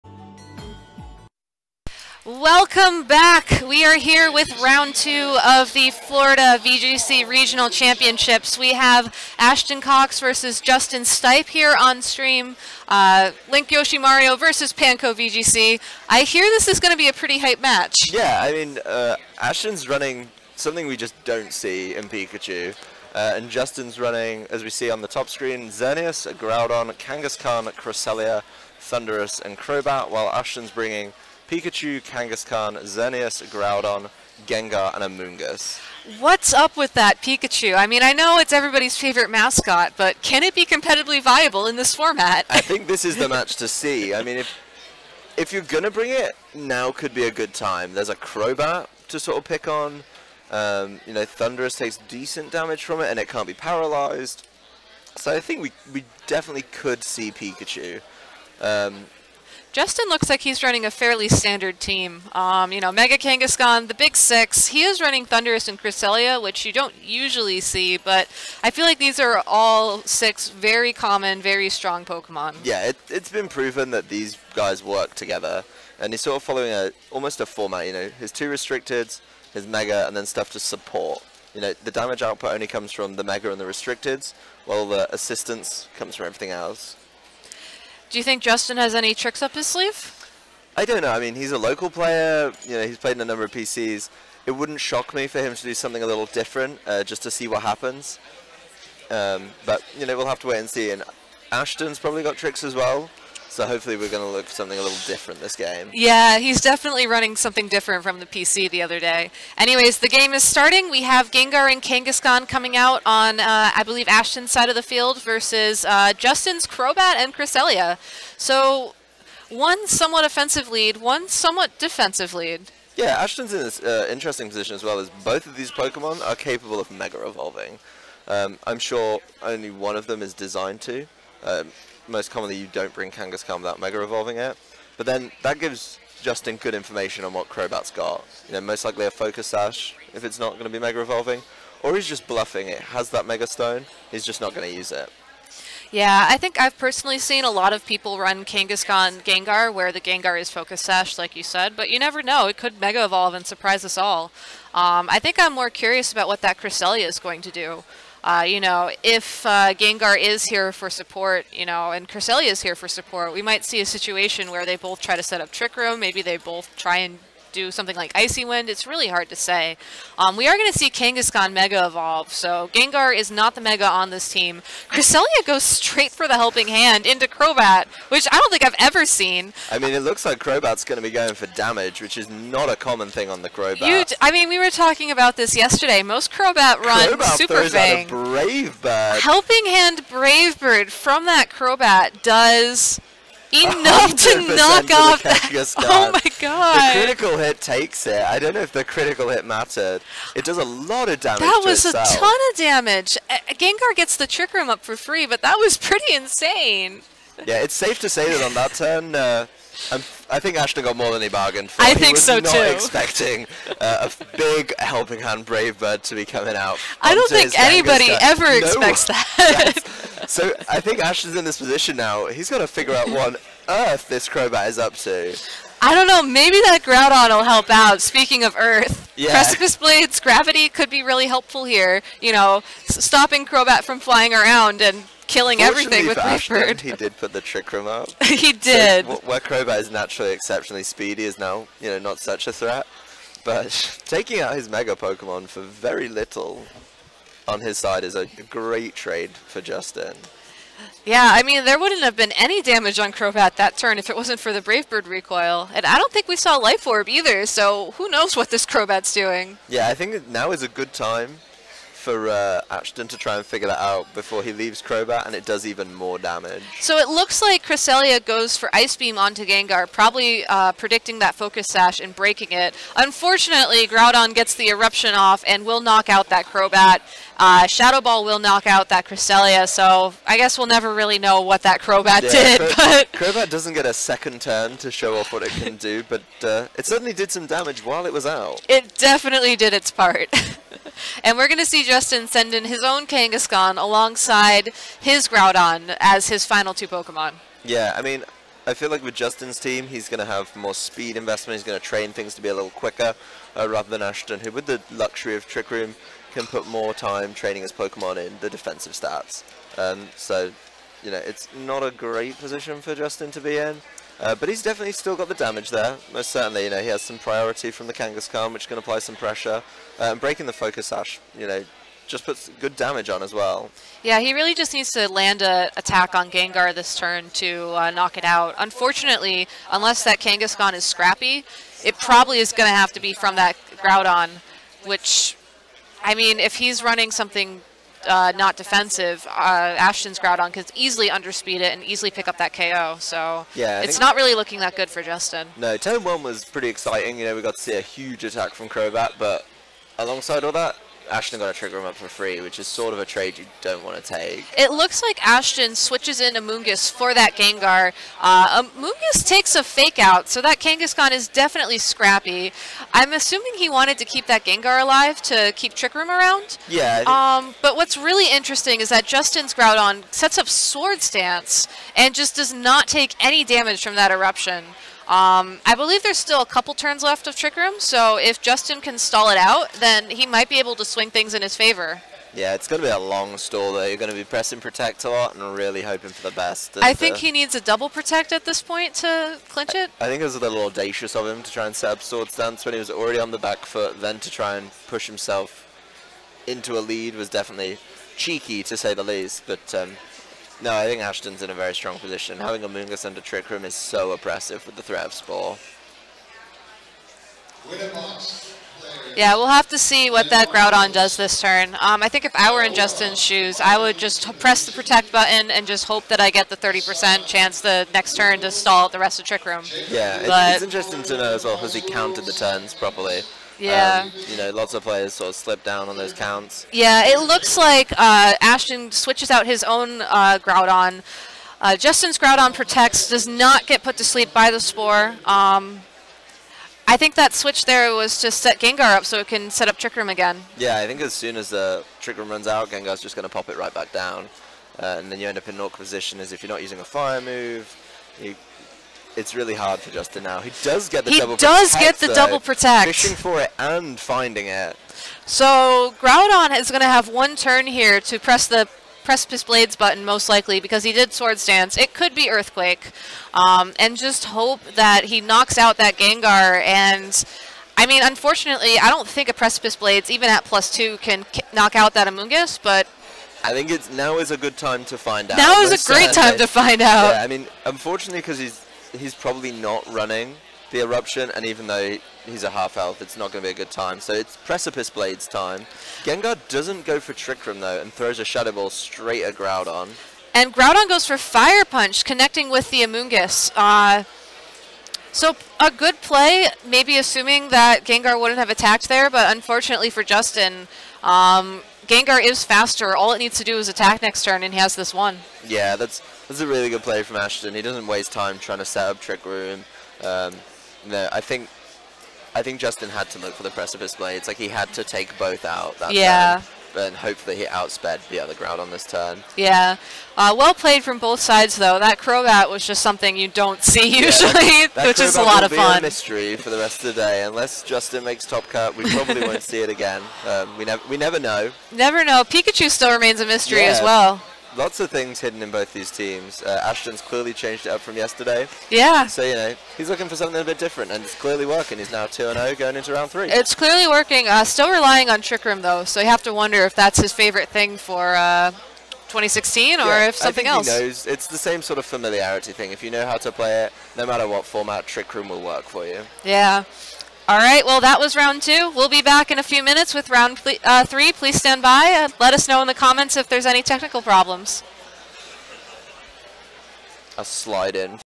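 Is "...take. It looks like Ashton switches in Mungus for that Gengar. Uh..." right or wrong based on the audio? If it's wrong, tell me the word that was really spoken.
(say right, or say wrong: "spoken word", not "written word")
right.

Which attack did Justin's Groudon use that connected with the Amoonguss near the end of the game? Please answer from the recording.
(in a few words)
Fire Punch.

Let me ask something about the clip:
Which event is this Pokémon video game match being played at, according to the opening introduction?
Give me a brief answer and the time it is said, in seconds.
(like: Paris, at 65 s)
Florida VGC Regional Championships, at 5 s.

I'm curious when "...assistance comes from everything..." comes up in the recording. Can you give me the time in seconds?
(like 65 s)
85 s.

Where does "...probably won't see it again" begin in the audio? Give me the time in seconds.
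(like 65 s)
528 s.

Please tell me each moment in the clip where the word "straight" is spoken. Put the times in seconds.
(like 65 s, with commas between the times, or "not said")
175 s, 488 s.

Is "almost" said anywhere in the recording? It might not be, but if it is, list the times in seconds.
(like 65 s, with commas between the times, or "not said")
77 s.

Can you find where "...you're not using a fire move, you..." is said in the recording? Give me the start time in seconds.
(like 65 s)
446 s.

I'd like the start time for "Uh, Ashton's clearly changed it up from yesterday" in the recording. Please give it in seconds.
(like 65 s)
536 s.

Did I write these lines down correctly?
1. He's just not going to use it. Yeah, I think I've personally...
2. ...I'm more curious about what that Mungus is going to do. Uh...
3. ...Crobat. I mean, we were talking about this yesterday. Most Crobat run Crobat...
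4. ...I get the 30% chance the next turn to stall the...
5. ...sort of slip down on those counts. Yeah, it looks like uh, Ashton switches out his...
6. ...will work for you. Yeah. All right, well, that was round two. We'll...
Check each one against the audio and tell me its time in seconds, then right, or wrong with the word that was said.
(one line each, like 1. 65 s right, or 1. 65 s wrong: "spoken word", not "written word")
1. 144 s right
2. 155 s wrong: "Cresselia", not "Mungus"
3. 183 s right
4. 416 s right
5. 425 s right
6. 555 s right.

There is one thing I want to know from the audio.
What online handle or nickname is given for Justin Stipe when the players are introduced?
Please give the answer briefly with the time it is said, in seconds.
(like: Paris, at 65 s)
Panko VGC, at 14 s.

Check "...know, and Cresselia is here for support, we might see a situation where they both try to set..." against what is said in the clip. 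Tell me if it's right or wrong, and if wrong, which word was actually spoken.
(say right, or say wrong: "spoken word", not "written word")
right.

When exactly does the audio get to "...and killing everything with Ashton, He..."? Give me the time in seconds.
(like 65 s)
234 s.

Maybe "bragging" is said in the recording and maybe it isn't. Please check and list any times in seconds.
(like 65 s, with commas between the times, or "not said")
not said.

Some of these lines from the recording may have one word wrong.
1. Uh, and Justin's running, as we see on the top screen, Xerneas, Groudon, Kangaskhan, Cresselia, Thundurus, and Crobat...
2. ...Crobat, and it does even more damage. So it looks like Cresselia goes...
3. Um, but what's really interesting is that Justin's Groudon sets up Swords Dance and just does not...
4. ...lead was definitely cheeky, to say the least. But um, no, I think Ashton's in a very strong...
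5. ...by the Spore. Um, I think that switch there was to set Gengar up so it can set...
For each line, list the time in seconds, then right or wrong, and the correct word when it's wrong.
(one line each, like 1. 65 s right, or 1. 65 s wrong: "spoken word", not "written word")
1. 23 s right
2. 264 s right
3. 367 s right
4. 396 s right
5. 434 s right.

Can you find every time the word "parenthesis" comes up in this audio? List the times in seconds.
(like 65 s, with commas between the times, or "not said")
not said.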